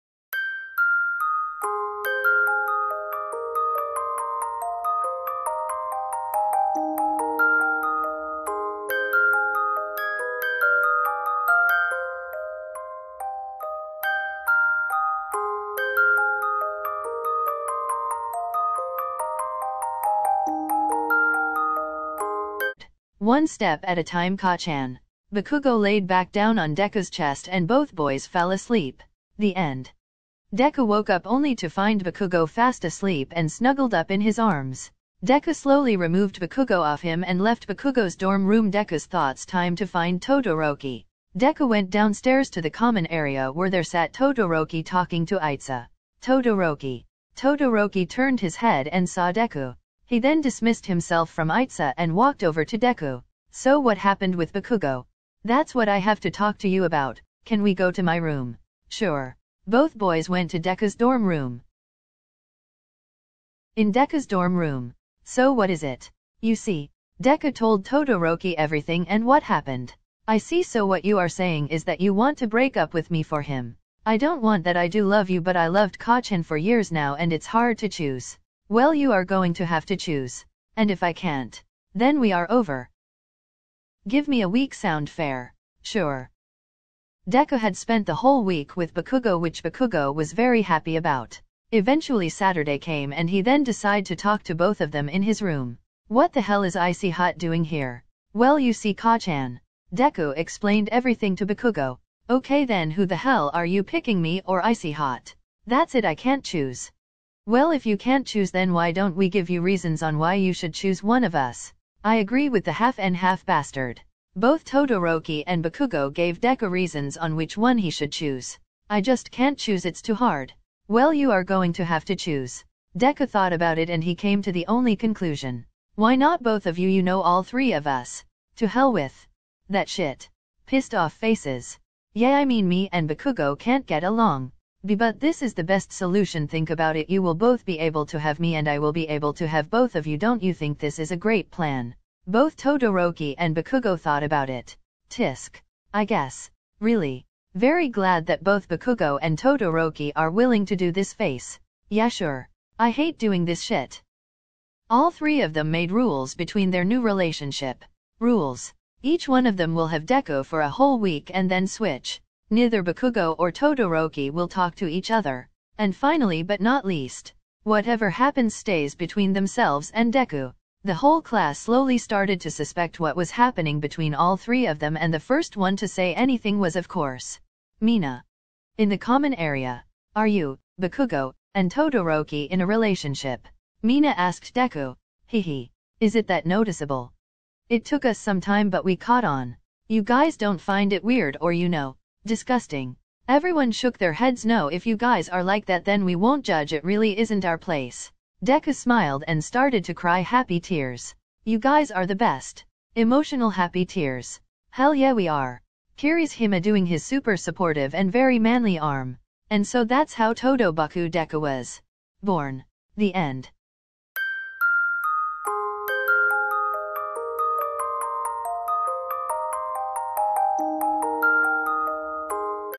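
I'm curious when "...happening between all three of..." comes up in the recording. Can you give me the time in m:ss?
2:53.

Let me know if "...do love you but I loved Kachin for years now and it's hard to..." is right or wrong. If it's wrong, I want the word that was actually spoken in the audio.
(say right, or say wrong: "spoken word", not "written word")
right.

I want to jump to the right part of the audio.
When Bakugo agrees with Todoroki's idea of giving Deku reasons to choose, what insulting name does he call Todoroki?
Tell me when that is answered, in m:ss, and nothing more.
1:52.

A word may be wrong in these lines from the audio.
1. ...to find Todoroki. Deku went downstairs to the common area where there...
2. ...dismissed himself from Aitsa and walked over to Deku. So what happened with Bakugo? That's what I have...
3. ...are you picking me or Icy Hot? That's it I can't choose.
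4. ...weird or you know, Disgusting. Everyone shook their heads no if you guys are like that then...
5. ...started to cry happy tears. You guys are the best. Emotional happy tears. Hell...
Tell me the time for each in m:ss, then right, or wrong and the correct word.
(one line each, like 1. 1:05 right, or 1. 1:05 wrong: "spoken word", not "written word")
1. 0:39 right
2. 0:50 right
3. 1:43 right
4. 3:11 right
5. 3:19 right.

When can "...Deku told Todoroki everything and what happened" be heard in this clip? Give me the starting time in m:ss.
1:07.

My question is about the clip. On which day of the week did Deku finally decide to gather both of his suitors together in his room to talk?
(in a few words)
Saturday.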